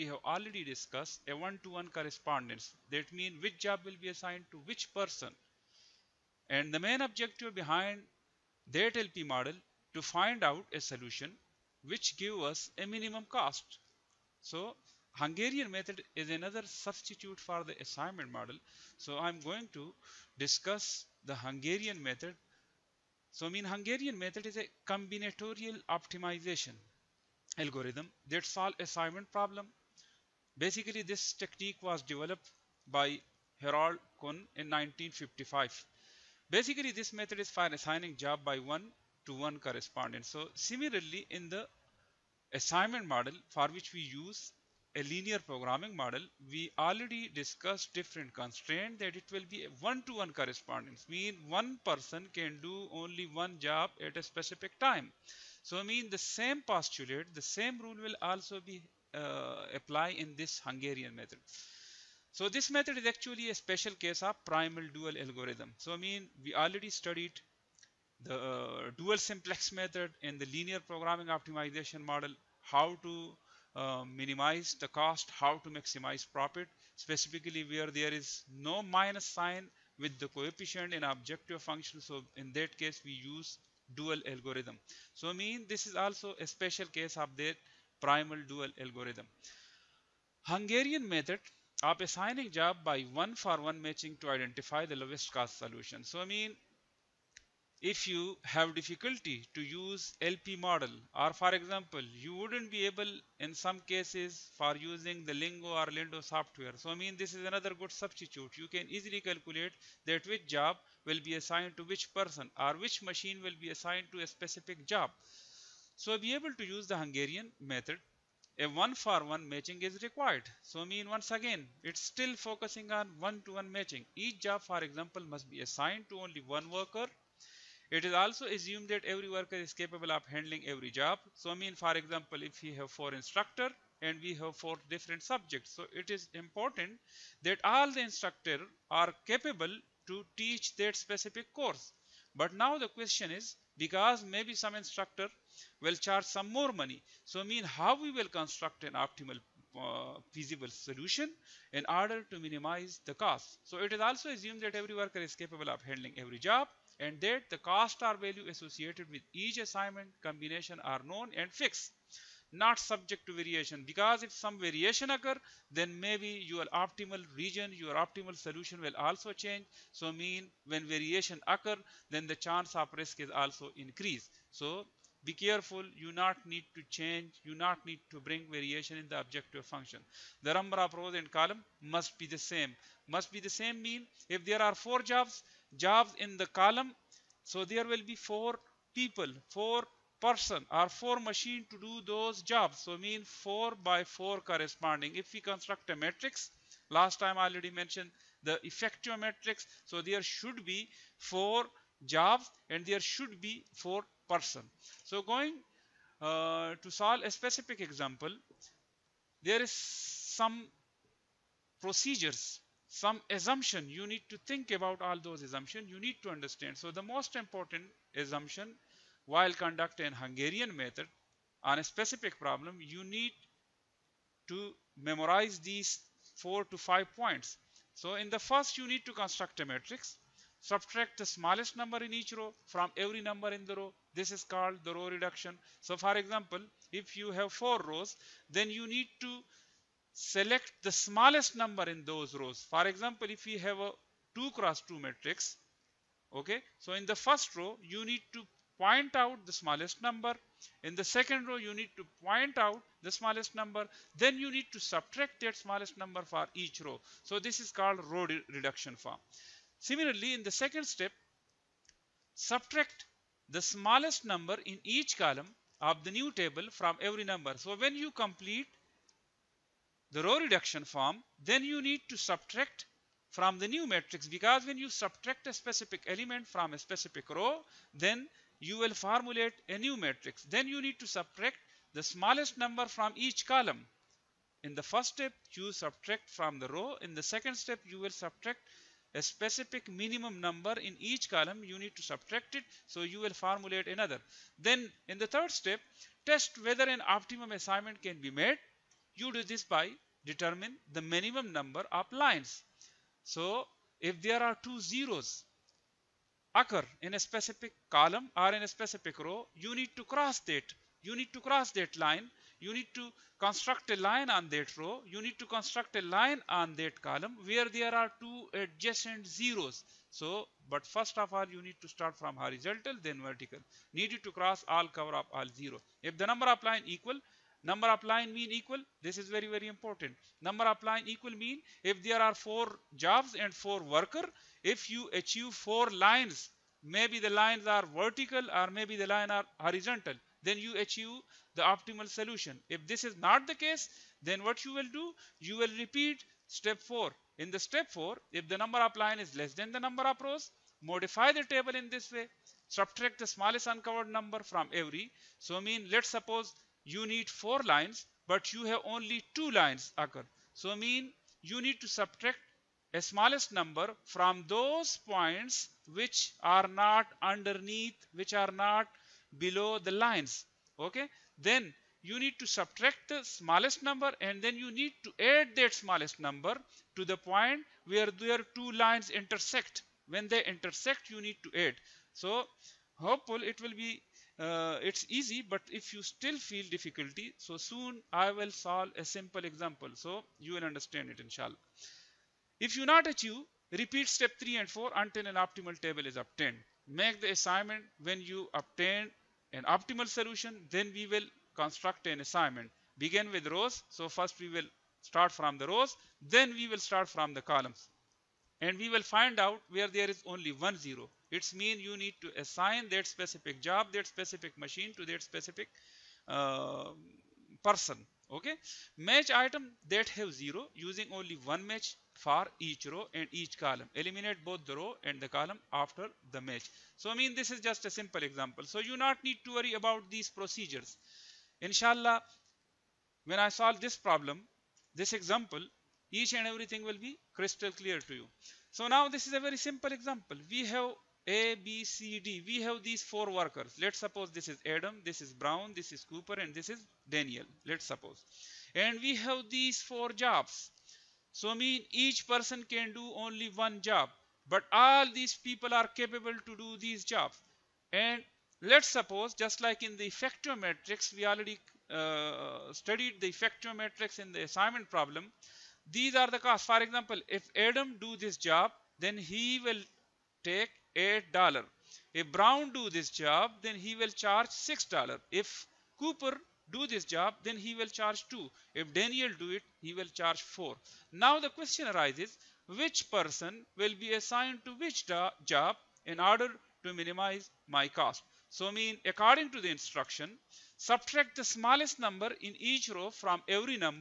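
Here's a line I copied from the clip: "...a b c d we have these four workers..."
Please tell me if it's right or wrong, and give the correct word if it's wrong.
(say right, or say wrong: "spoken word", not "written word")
right.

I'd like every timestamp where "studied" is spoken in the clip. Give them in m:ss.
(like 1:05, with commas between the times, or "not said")
1:06, 7:42.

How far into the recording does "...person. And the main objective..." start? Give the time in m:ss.
0:04.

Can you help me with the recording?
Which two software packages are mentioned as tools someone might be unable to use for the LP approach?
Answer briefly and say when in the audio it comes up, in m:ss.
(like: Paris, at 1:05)
Lingo or Lindo, at 1:45.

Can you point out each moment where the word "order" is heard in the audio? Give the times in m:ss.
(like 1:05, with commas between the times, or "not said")
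2:31, 8:06.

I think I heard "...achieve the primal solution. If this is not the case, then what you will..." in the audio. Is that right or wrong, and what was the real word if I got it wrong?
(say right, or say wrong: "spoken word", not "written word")
wrong: "optimal", not "primal".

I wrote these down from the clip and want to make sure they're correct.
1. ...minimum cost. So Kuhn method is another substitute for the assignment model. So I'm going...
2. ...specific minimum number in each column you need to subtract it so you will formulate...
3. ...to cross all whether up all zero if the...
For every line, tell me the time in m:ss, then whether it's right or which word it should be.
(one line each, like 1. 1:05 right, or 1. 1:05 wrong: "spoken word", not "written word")
1. 0:12 wrong: "Hungarian", not "Kuhn"
2. 4:49 right
3. 5:24 wrong: "cover", not "whether".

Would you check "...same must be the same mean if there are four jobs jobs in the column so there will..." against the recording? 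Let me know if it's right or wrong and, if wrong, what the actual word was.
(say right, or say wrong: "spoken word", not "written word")
right.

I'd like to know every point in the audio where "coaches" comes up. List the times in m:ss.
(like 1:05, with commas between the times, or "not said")
not said.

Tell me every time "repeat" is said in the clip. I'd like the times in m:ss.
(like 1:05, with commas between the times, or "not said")
5:45, 6:33.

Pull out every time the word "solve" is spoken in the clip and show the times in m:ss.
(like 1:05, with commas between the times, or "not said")
0:28, 3:26, 6:28, 7:13.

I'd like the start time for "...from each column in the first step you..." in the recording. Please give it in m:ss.
4:42.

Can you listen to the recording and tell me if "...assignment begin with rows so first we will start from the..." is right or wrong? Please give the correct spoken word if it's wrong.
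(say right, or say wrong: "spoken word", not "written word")
right.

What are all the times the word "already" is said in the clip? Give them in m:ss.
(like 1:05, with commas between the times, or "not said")
0:00, 0:46, 1:06, 3:17, 7:41.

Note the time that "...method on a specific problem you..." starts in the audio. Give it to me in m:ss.
3:40.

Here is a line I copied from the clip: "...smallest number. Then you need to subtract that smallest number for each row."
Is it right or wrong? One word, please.
right.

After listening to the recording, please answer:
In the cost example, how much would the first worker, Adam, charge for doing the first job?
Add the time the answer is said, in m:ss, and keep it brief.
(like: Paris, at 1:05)
$8, at 7:50.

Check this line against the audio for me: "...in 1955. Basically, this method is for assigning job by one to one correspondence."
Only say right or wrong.
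right.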